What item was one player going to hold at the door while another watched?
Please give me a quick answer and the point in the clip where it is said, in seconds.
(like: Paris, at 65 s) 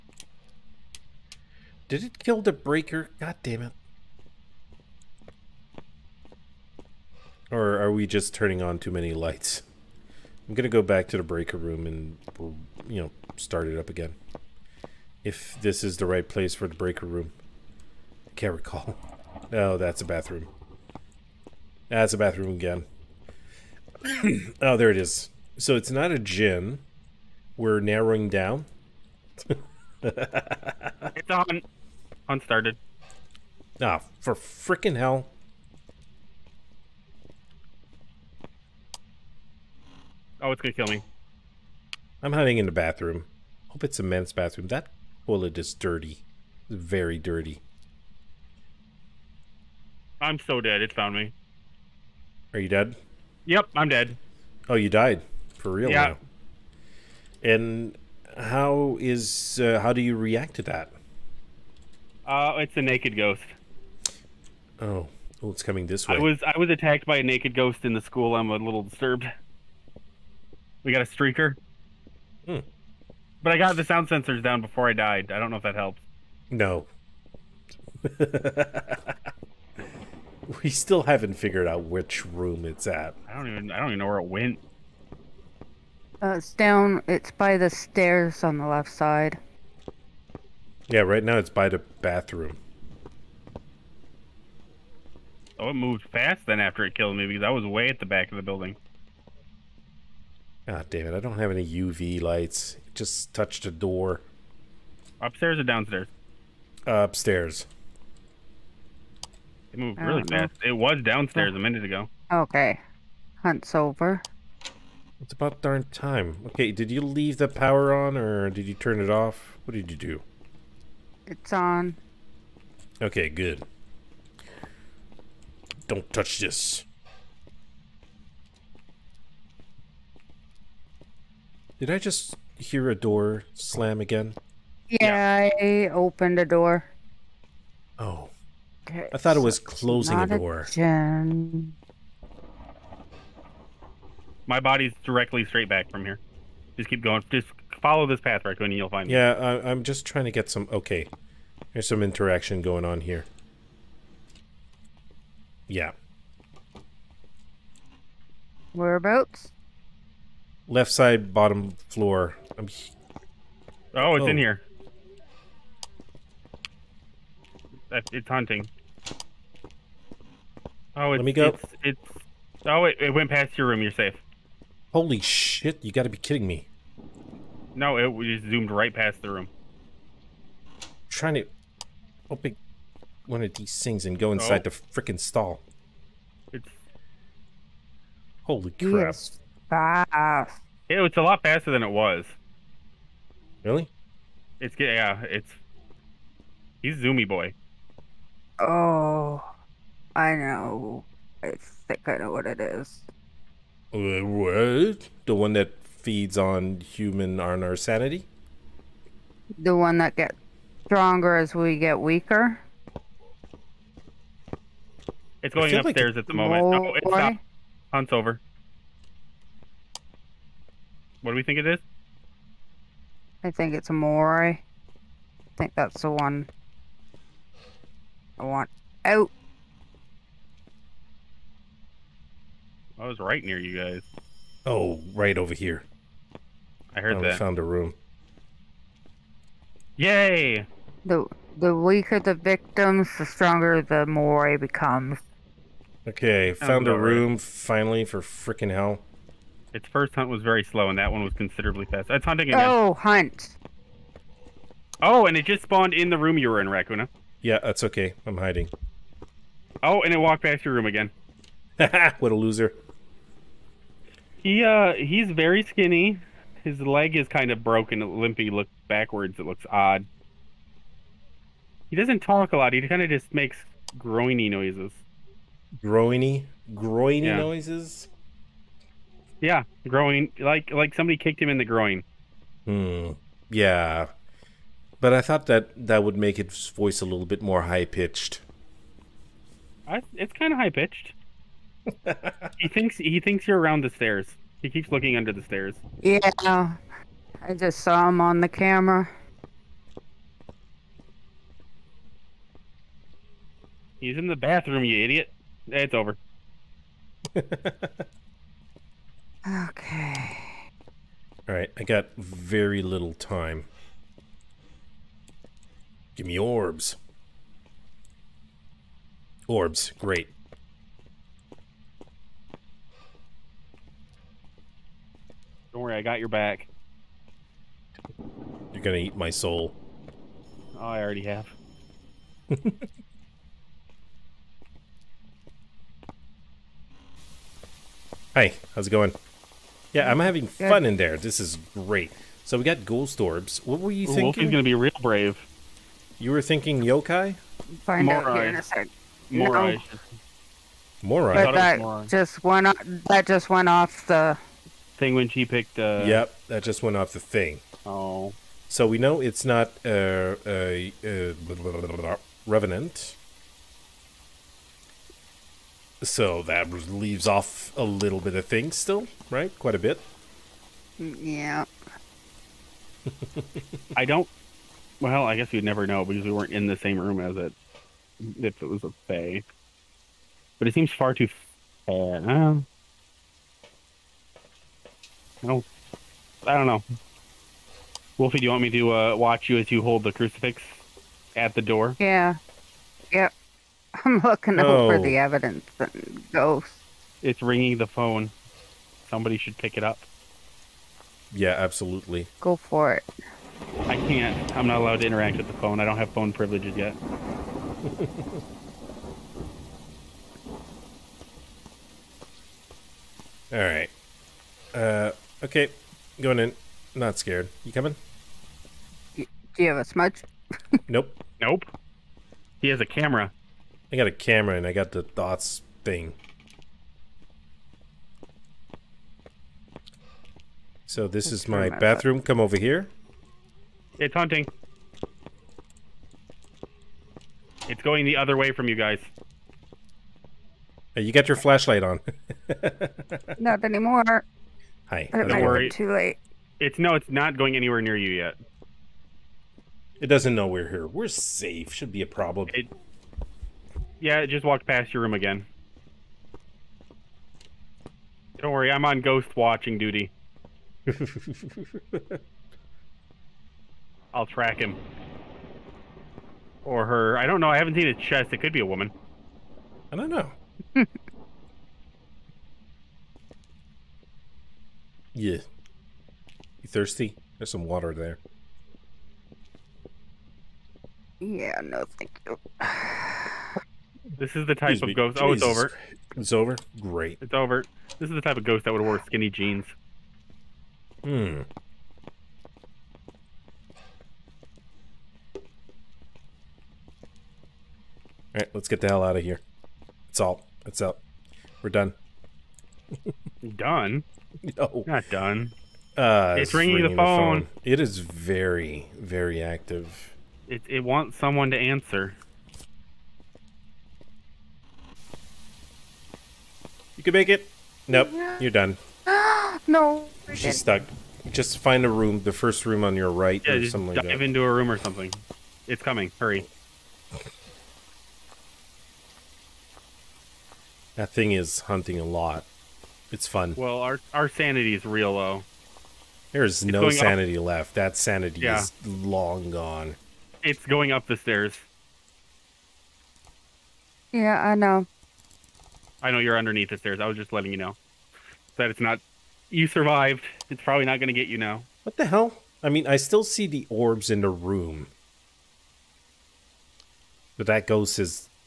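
Crucifix, at 390 s.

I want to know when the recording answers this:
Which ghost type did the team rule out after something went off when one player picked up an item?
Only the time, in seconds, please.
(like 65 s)
362 s.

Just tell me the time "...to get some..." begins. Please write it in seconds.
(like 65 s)
150 s.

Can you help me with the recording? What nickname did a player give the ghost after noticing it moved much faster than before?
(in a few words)
Zoomy boy.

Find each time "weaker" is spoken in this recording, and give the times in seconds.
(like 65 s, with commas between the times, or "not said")
211 s, 241 s.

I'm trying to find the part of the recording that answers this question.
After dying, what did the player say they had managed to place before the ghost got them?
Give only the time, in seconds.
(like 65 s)
73 s.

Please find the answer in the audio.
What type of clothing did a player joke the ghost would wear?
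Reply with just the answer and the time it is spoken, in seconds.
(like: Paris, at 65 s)
Skinny jeans, at 489 s.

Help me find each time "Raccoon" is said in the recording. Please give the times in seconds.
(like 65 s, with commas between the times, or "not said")
148 s, 256 s.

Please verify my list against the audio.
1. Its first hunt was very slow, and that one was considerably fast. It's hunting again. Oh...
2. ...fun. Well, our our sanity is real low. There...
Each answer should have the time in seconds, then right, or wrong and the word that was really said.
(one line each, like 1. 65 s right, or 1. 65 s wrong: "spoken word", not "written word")
1. 249 s right
2. 533 s right.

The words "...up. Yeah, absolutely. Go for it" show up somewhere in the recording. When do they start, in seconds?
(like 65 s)
399 s.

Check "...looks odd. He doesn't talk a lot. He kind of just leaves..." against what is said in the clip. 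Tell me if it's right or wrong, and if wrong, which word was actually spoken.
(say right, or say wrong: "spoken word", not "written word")
wrong: "makes", not "leaves".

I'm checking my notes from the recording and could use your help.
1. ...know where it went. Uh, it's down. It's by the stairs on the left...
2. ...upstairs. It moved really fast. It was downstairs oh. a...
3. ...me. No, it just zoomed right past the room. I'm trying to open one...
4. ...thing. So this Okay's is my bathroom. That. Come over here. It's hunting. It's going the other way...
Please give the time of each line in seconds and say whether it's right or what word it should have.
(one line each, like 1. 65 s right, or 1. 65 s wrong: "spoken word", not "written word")
1. 83 s right
2. 106 s right
3. 176 s right
4. 425 s wrong: "Let", not "Okay".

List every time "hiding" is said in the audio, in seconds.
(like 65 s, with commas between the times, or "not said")
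42 s, 258 s.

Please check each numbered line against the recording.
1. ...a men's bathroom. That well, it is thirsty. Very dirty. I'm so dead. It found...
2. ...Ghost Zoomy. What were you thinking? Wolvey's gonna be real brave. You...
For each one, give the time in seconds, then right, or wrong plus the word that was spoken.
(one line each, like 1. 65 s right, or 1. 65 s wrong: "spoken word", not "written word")
1. 43 s wrong: "dirty", not "thirsty"
2. 342 s wrong: "Orbs", not "Zoomy".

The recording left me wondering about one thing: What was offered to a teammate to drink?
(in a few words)
Water.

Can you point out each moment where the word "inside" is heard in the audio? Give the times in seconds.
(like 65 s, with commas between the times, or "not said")
184 s.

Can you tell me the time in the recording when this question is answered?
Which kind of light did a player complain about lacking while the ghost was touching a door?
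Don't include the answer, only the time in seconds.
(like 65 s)
101 s.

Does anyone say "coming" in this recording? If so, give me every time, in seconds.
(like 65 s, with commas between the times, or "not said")
65 s, 417 s, 525 s.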